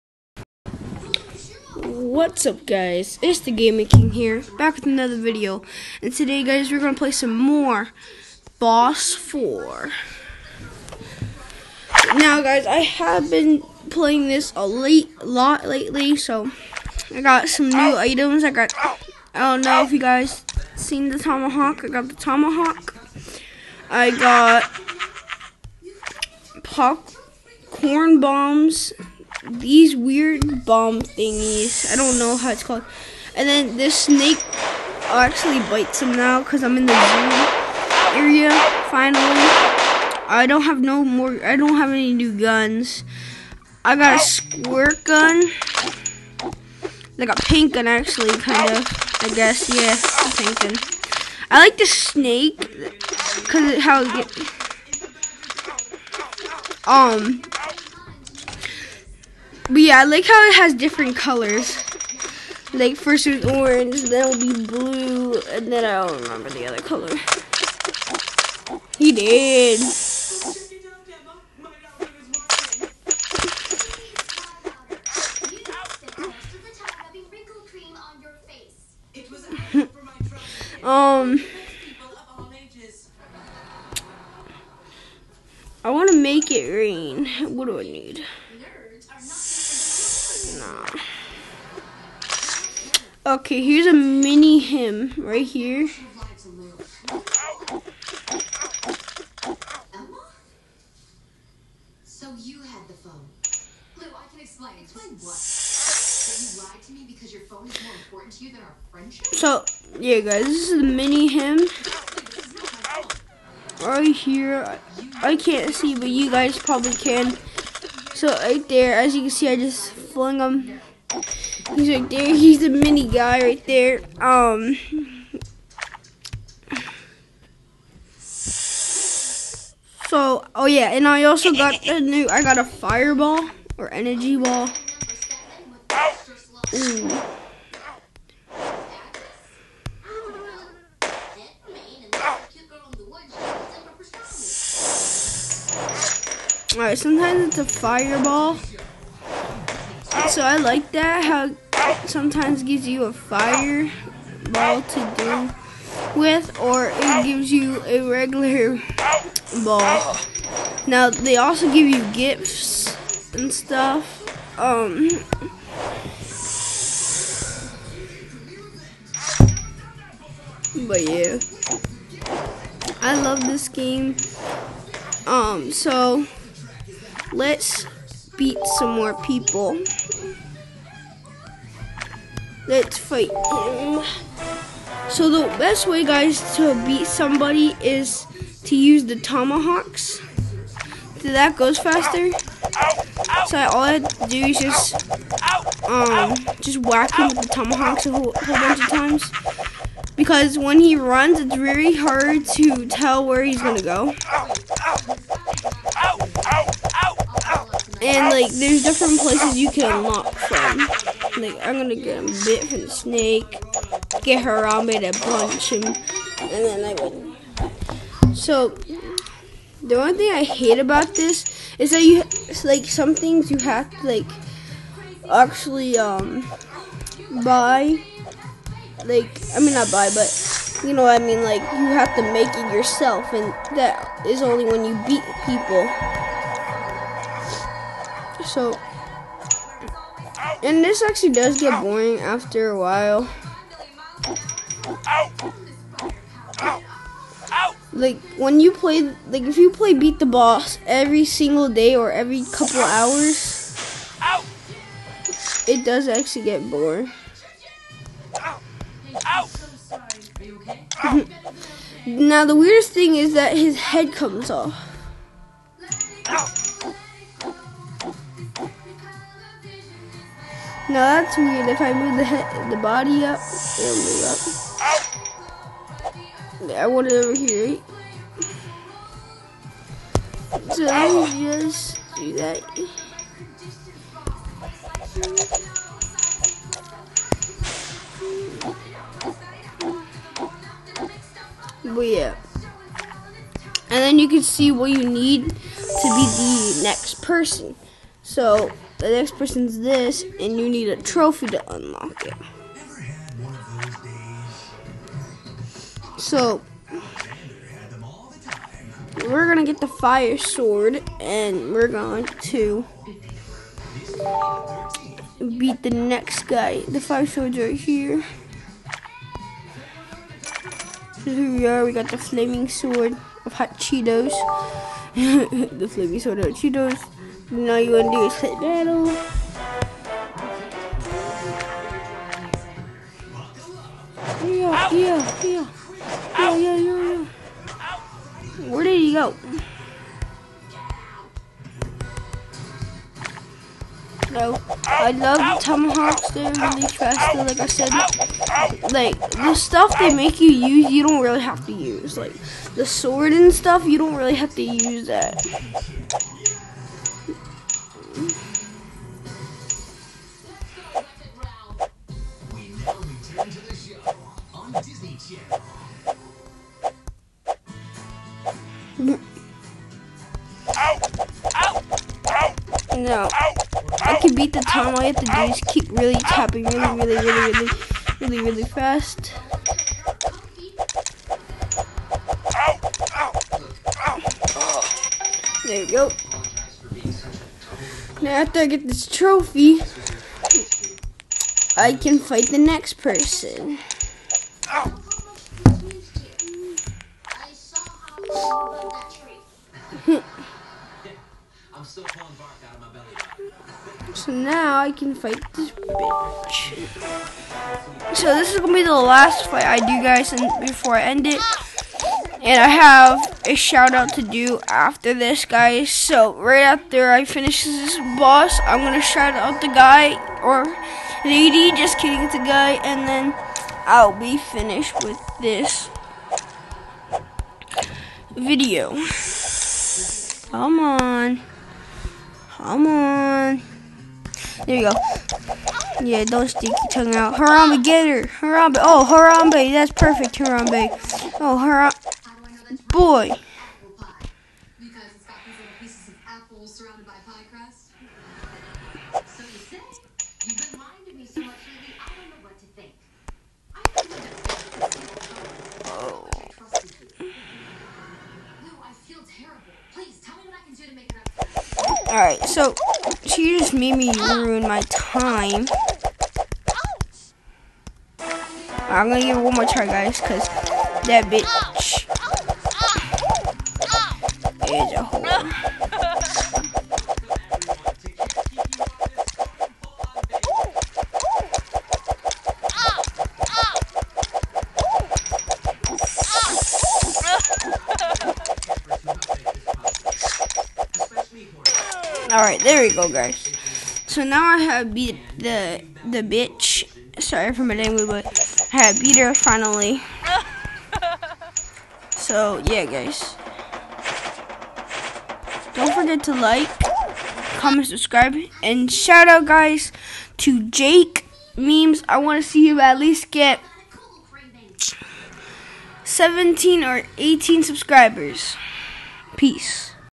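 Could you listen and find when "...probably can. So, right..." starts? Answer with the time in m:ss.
1:56.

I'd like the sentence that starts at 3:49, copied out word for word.
Like, I mean, not buy, but you know what I mean?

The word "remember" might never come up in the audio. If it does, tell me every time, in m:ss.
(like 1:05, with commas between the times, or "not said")
1:06.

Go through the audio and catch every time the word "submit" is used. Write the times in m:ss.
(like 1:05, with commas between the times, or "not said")
not said.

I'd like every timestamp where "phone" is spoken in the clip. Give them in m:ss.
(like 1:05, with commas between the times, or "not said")
1:42, 1:47.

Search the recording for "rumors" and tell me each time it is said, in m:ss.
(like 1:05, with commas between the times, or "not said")
not said.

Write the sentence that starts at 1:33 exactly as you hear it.
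Okay, here's a mini him right here.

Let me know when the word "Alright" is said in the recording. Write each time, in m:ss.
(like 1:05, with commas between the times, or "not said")
2:26, 8:12.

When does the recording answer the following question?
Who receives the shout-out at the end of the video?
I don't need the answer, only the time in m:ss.
8:30.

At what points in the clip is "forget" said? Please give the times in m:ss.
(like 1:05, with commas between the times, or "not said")
8:25.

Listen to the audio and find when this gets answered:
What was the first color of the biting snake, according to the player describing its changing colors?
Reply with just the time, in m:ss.
1:03.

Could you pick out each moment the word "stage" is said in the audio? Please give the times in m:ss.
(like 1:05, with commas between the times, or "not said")
not said.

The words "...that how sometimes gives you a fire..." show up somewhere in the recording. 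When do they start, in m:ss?
2:30.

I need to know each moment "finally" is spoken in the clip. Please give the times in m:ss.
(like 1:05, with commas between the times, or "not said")
0:38, 8:19.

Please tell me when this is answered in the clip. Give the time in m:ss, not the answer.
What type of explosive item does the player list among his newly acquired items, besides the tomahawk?
0:26.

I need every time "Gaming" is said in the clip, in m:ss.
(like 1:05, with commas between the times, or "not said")
0:03.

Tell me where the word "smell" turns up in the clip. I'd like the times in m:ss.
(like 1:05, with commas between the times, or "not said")
not said.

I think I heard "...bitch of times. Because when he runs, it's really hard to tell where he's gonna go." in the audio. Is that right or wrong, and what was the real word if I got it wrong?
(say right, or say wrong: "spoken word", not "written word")
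wrong: "bunch", not "bitch".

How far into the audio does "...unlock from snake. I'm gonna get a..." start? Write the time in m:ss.
3:29.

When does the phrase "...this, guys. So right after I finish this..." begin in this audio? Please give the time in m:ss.
6:55.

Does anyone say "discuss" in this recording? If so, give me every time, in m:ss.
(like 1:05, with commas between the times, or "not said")
not said.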